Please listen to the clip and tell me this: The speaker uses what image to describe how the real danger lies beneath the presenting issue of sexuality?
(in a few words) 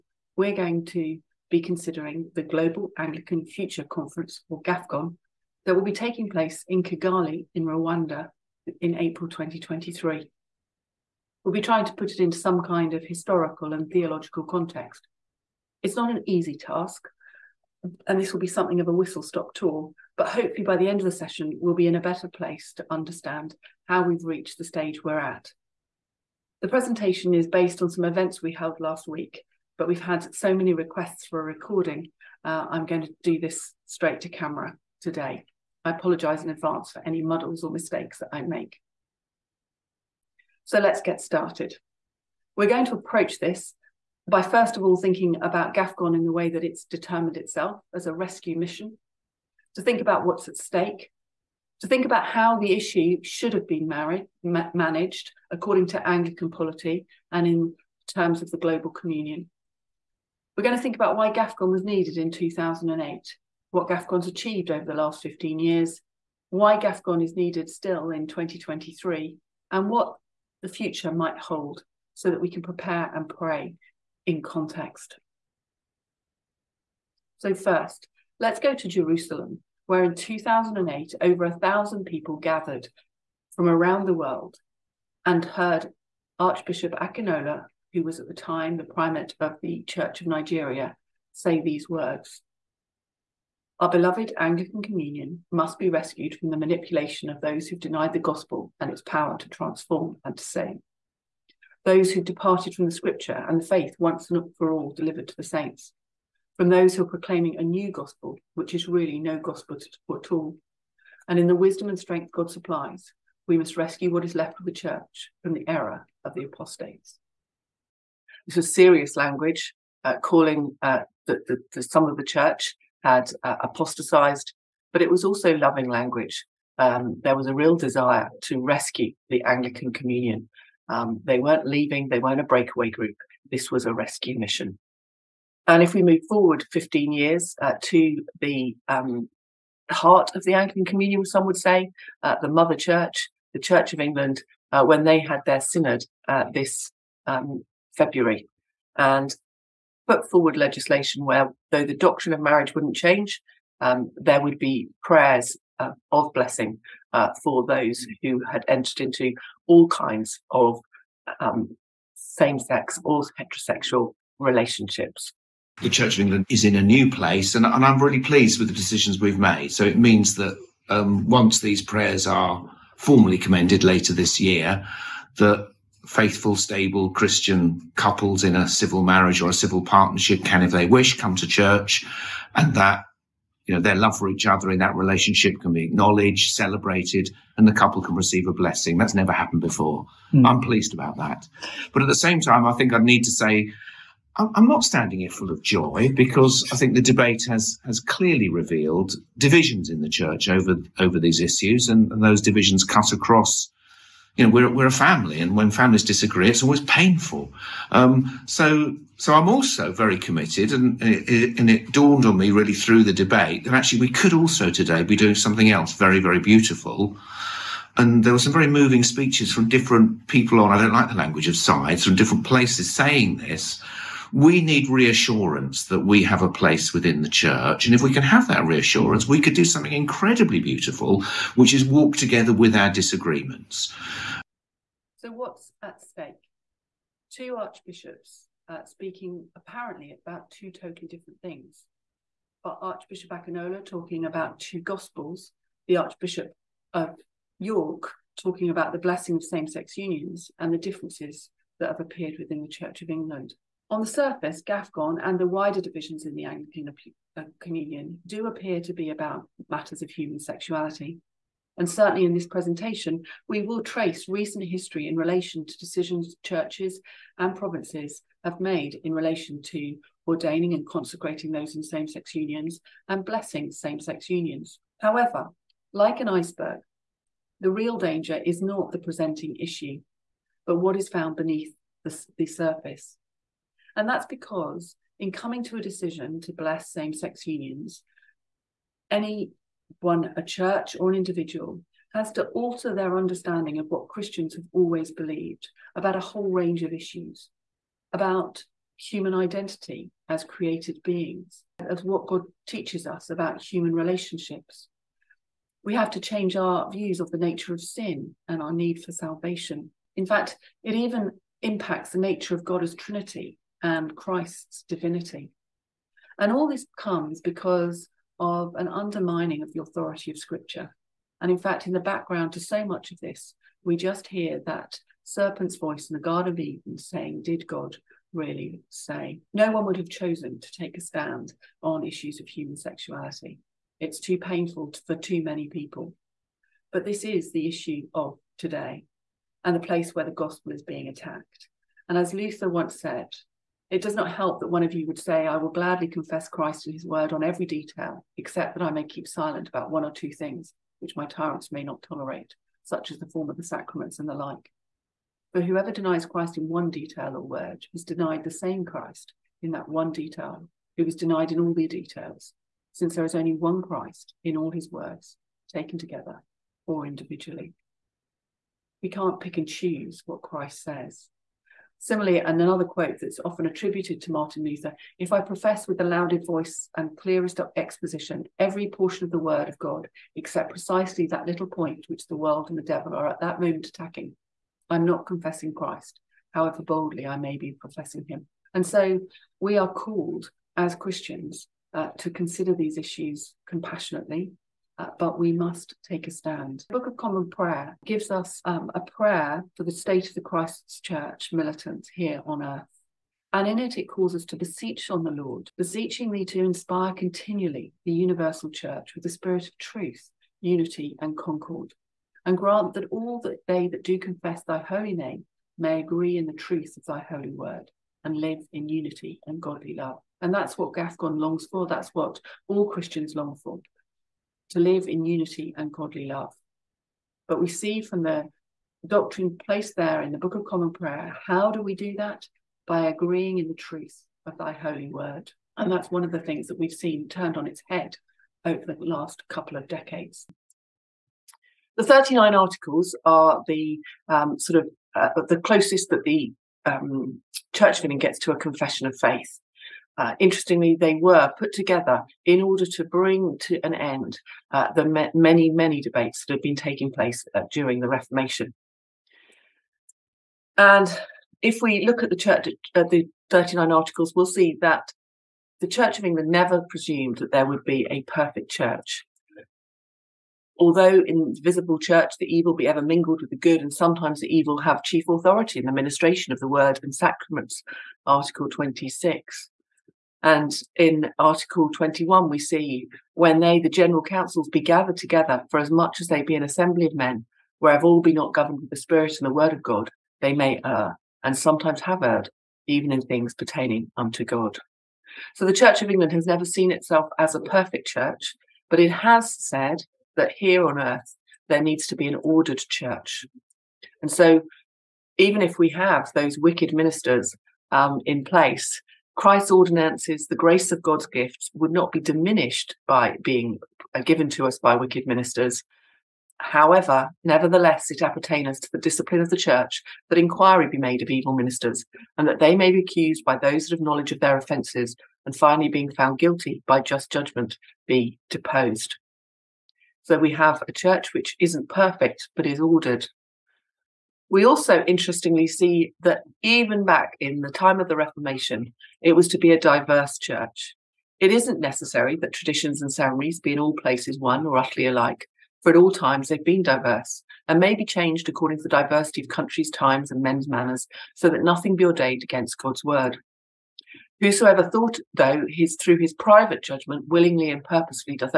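An iceberg.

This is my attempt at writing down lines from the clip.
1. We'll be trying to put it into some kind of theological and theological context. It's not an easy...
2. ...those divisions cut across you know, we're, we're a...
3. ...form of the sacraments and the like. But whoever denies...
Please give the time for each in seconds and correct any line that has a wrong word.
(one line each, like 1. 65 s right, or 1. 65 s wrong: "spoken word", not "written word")
1. 11 s wrong: "historical", not "theological"
2. 202 s right
3. 353 s right.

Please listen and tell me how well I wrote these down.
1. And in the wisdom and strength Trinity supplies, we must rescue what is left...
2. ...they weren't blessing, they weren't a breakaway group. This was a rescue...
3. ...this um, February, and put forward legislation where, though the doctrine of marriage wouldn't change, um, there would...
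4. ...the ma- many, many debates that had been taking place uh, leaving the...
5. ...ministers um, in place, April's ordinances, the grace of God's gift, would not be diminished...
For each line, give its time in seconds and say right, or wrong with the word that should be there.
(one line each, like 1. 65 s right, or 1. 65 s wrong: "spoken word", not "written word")
1. 111 s wrong: "God", not "Trinity"
2. 131 s wrong: "leaving", not "blessing"
3. 146 s right
4. 454 s wrong: "during", not "leaving"
5. 506 s wrong: "Christ", not "April".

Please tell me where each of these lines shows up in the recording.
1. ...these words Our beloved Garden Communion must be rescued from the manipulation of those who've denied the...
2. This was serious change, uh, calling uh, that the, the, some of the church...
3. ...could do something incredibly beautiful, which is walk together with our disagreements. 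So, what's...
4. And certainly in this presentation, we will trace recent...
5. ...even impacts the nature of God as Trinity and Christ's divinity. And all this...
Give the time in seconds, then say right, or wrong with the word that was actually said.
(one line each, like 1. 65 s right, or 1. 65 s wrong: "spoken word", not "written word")
1. 91 s wrong: "Anglican", not "Garden"
2. 118 s wrong: "language", not "change"
3. 229 s right
4. 261 s right
5. 310 s right.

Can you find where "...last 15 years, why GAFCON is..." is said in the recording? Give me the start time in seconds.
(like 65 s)
64 s.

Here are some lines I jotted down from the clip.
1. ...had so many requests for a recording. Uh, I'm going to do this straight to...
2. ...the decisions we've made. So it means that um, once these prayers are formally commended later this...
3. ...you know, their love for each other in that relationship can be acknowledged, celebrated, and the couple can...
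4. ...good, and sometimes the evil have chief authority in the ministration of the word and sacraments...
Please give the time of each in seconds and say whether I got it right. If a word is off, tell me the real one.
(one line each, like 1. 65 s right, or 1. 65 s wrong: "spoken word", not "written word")
1. 30 s right
2. 168 s right
3. 183 s right
4. 473 s right.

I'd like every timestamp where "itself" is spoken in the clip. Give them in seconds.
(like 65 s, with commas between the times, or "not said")
47 s, 496 s.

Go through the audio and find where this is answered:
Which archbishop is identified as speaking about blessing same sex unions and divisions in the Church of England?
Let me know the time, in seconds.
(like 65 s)
245 s.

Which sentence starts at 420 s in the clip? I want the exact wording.
And that's what GAFCON longs for.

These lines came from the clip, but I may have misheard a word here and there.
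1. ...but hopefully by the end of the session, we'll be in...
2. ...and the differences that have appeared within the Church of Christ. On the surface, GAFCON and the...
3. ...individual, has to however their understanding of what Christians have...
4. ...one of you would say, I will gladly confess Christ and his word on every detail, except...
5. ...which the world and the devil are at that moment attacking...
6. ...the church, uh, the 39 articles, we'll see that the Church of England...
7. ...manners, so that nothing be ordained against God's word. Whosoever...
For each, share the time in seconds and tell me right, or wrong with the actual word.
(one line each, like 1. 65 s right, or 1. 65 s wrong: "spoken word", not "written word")
1. 20 s right
2. 250 s wrong: "England", not "Christ"
3. 291 s wrong: "alter", not "however"
4. 344 s right
5. 382 s right
6. 462 s right
7. 550 s right.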